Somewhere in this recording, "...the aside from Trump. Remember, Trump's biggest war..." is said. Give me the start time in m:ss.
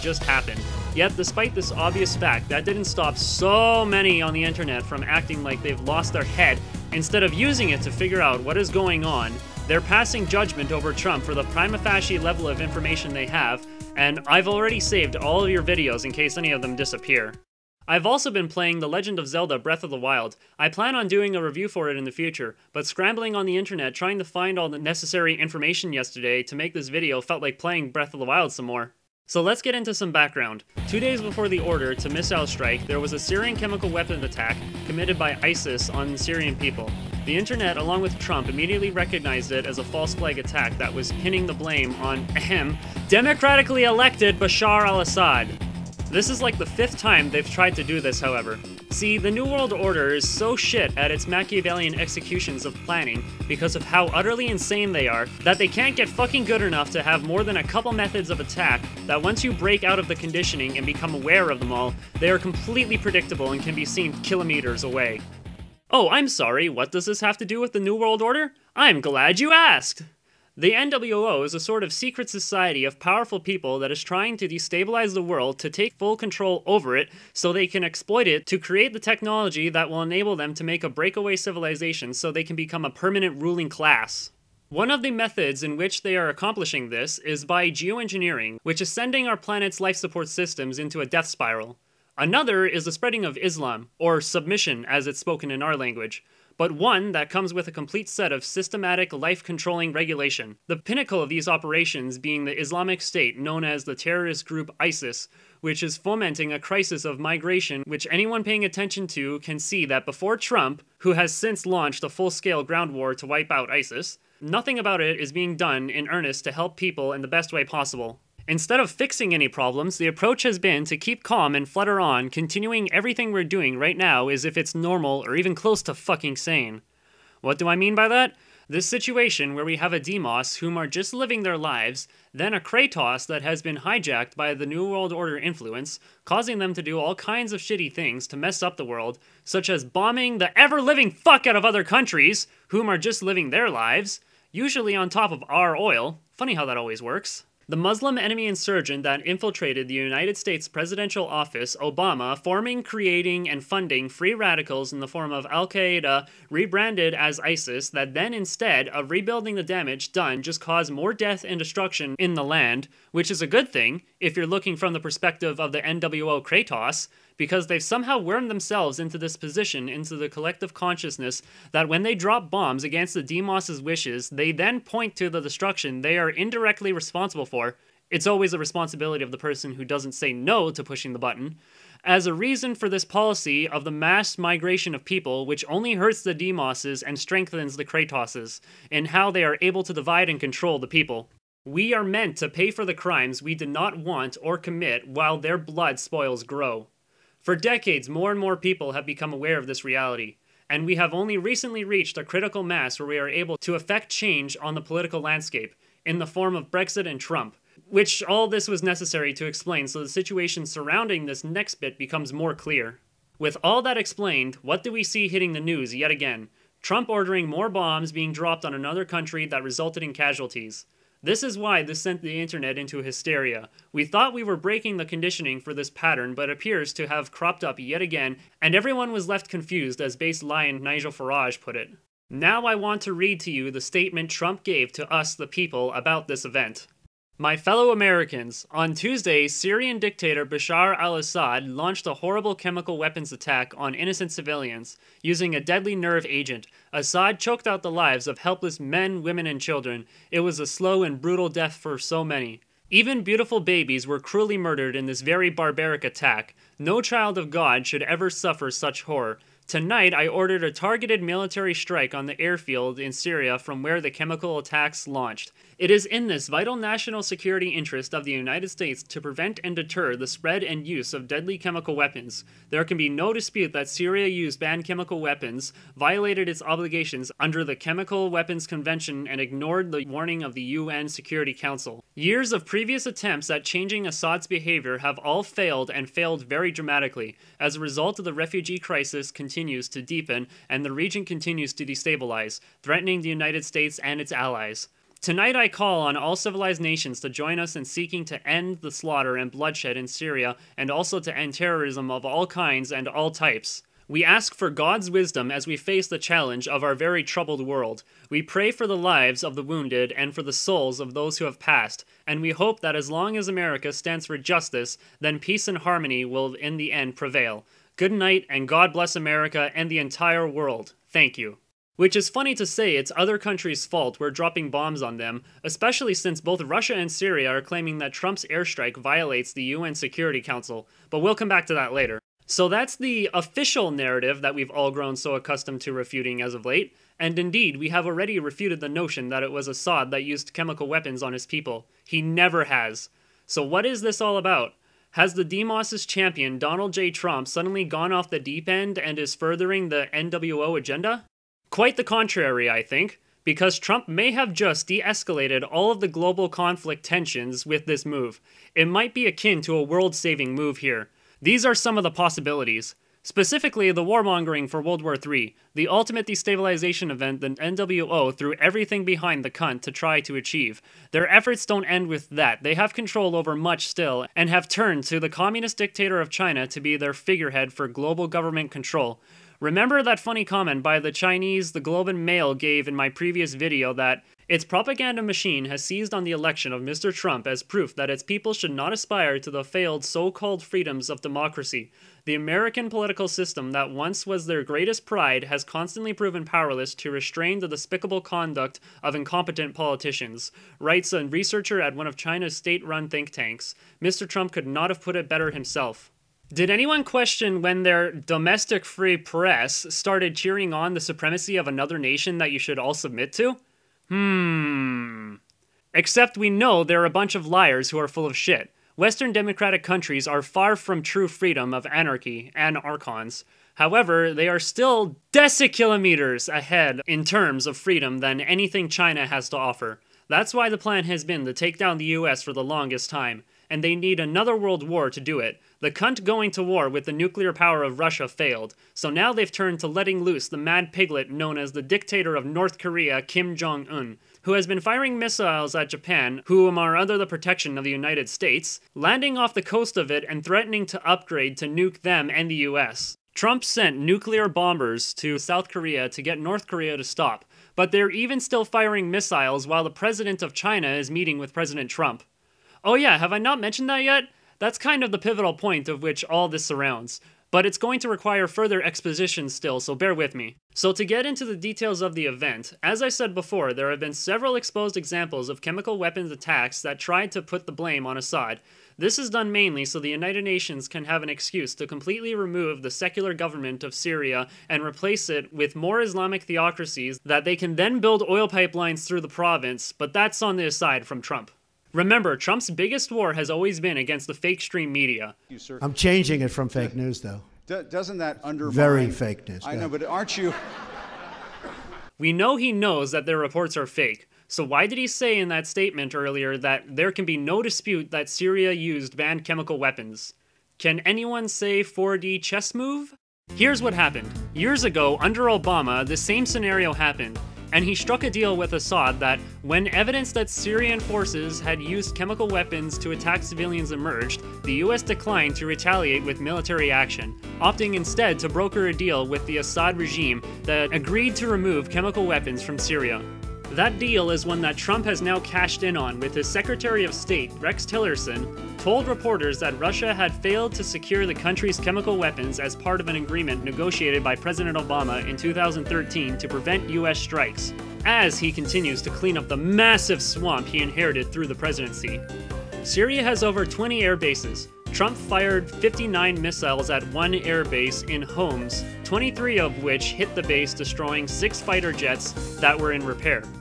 8:10.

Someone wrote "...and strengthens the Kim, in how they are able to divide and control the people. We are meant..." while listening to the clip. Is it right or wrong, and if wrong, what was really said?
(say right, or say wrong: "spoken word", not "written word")
wrong: "Kratoses", not "Kim".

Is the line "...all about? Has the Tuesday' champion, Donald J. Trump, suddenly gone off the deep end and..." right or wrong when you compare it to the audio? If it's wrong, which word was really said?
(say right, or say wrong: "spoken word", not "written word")
wrong: "Demos", not "Tuesday".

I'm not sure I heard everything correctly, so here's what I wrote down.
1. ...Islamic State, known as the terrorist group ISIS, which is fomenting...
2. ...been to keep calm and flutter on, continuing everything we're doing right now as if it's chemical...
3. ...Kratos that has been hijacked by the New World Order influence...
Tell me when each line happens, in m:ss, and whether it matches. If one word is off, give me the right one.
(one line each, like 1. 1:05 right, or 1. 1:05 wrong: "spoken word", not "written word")
1. 1:42 right
2. 2:00 wrong: "normal", not "chemical"
3. 2:12 right.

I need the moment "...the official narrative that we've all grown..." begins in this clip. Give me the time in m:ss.
5:32.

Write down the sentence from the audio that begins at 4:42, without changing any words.
Years of previous attempts at changing Assad's behavior have all failed and failed very dramatically.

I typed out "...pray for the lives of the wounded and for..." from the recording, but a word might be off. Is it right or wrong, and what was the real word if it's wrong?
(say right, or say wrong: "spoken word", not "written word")
right.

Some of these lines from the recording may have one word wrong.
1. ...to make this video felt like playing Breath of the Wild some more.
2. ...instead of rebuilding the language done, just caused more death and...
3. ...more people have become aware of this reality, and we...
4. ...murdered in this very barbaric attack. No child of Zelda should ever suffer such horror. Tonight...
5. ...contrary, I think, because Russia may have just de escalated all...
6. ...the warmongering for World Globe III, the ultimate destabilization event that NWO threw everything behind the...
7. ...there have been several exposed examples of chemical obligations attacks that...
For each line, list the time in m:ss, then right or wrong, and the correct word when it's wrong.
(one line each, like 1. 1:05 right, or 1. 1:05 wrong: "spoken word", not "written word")
1. 0:26 right
2. 2:38 wrong: "damage", not "language"
3. 3:18 right
4. 4:14 wrong: "God", not "Zelda"
5. 5:52 wrong: "Trump", not "Russia"
6. 6:03 wrong: "War", not "Globe"
7. 7:53 wrong: "weapons", not "obligations".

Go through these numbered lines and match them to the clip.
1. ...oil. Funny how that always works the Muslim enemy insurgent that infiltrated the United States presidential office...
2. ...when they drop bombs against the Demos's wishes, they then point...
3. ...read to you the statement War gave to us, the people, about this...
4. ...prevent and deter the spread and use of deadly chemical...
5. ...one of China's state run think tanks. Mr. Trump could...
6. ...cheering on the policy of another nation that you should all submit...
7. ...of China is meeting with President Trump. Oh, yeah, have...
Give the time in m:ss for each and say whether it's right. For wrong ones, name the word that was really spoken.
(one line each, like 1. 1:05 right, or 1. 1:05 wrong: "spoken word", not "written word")
1. 2:25 right
2. 2:51 right
3. 3:53 wrong: "Trump", not "War"
4. 4:29 right
5. 6:41 right
6. 6:50 wrong: "supremacy", not "policy"
7. 7:40 right.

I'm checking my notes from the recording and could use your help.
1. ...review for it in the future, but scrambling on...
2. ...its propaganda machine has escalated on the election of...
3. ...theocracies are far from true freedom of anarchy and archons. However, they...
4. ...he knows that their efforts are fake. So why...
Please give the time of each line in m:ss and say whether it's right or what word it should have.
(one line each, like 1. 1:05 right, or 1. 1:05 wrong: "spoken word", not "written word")
1. 0:21 right
2. 6:24 wrong: "seized", not "escalated"
3. 6:59 wrong: "countries", not "theocracies"
4. 8:22 wrong: "reports", not "efforts".